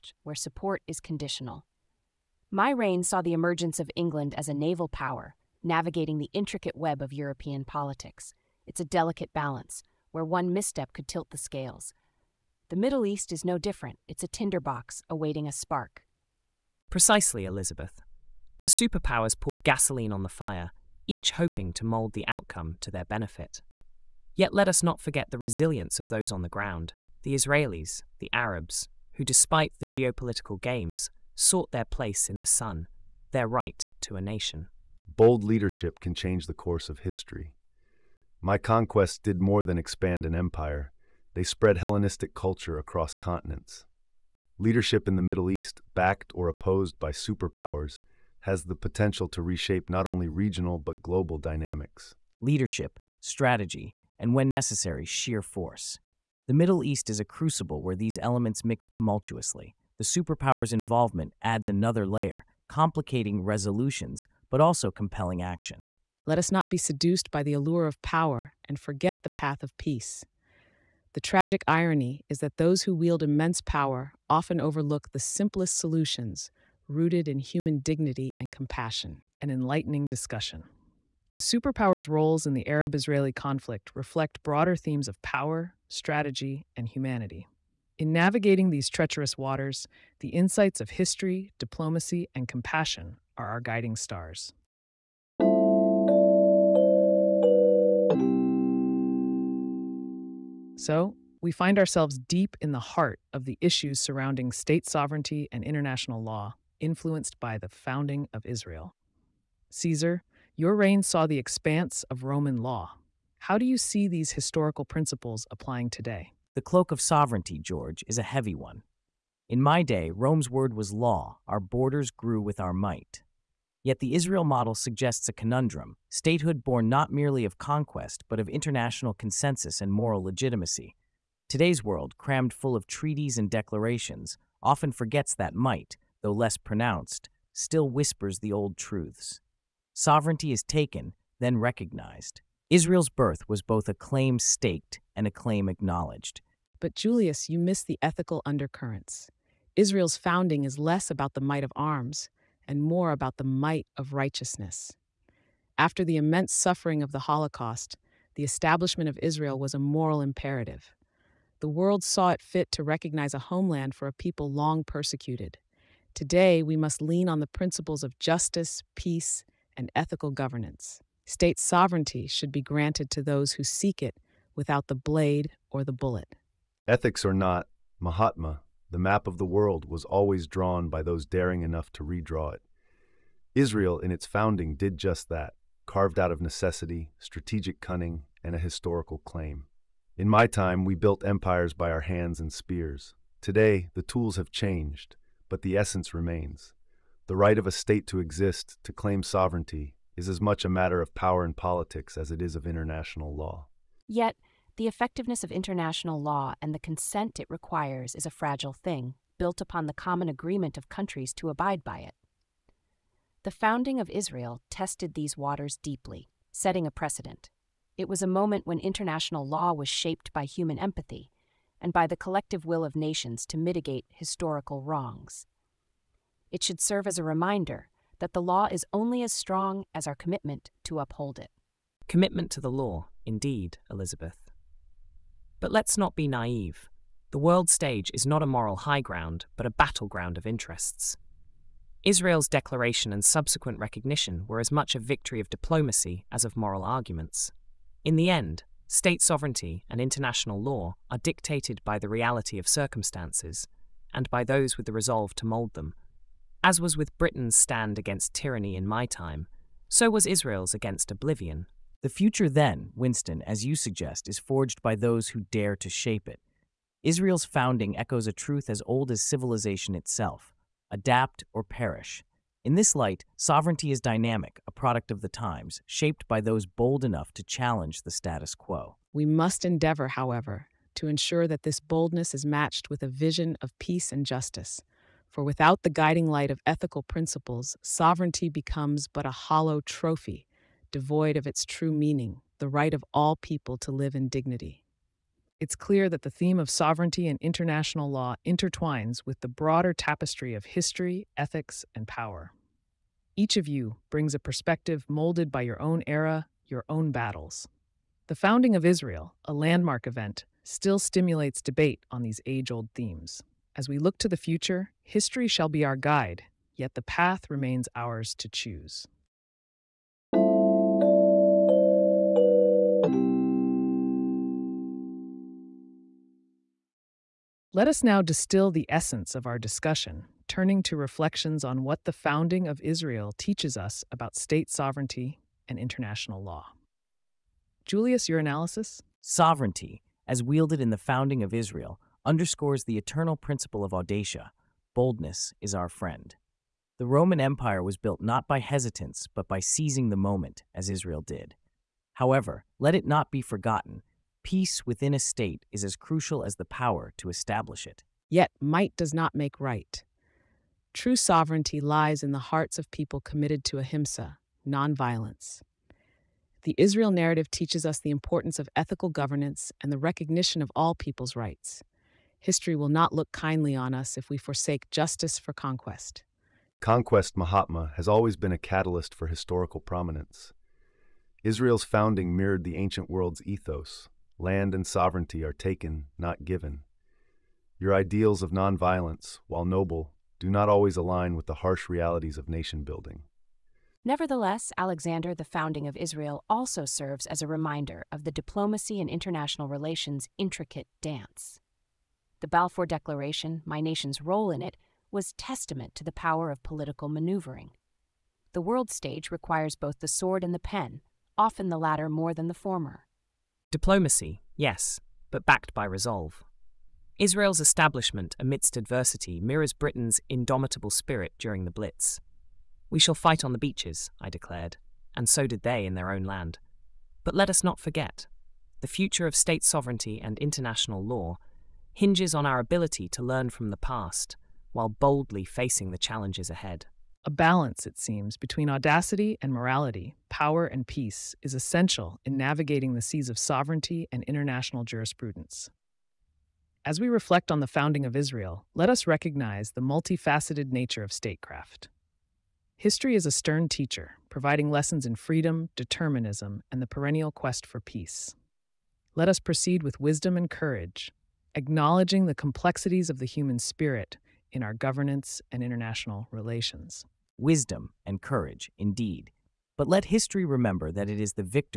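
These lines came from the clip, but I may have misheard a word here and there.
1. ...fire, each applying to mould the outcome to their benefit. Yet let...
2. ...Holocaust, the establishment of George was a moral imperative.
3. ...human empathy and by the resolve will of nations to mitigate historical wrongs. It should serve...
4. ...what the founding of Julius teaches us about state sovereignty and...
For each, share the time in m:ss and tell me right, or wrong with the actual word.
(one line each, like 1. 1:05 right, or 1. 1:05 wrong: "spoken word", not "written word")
1. 0:20 wrong: "hoping", not "applying"
2. 2:37 wrong: "Israel", not "George"
3. 3:40 wrong: "collective", not "resolve"
4. 5:31 wrong: "Israel", not "Julius".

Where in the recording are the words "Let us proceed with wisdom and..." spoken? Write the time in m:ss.
7:39.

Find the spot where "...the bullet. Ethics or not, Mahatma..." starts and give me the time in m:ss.
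2:55.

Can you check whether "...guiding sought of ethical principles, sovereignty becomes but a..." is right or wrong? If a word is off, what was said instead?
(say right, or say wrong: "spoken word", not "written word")
wrong: "light", not "sought".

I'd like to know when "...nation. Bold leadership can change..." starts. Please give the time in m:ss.
0:34.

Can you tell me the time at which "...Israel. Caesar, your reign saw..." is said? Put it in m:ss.
1:48.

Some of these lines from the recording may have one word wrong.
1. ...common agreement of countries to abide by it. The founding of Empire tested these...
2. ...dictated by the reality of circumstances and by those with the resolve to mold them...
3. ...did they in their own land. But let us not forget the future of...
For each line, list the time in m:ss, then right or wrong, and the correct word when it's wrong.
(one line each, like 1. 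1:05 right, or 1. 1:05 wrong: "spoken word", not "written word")
1. 3:29 wrong: "Israel", not "Empire"
2. 4:11 right
3. 7:05 right.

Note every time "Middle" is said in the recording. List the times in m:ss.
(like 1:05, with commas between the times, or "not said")
0:12, 0:45, 0:56.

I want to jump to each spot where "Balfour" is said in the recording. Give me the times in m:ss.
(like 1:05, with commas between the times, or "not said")
6:42.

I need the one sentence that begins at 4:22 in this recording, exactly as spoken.
The future, then, Winston, as you suggest, is forged by those who dare to shape it.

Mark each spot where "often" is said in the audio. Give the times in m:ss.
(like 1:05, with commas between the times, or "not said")
1:14, 2:14, 6:51.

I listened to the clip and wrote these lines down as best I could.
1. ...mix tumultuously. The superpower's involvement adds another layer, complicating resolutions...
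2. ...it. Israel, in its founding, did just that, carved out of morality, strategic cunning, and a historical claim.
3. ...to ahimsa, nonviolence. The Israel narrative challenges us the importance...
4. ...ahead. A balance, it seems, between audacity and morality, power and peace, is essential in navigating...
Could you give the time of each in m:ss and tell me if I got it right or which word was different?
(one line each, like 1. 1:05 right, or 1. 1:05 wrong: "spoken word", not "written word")
1. 0:58 right
2. 3:02 wrong: "necessity", not "morality"
3. 6:03 wrong: "teaches", not "challenges"
4. 7:16 right.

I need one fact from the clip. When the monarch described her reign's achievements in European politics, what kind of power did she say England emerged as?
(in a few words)
naval power.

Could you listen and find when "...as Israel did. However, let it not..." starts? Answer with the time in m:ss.
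5:50.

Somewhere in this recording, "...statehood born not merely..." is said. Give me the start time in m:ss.
2:06.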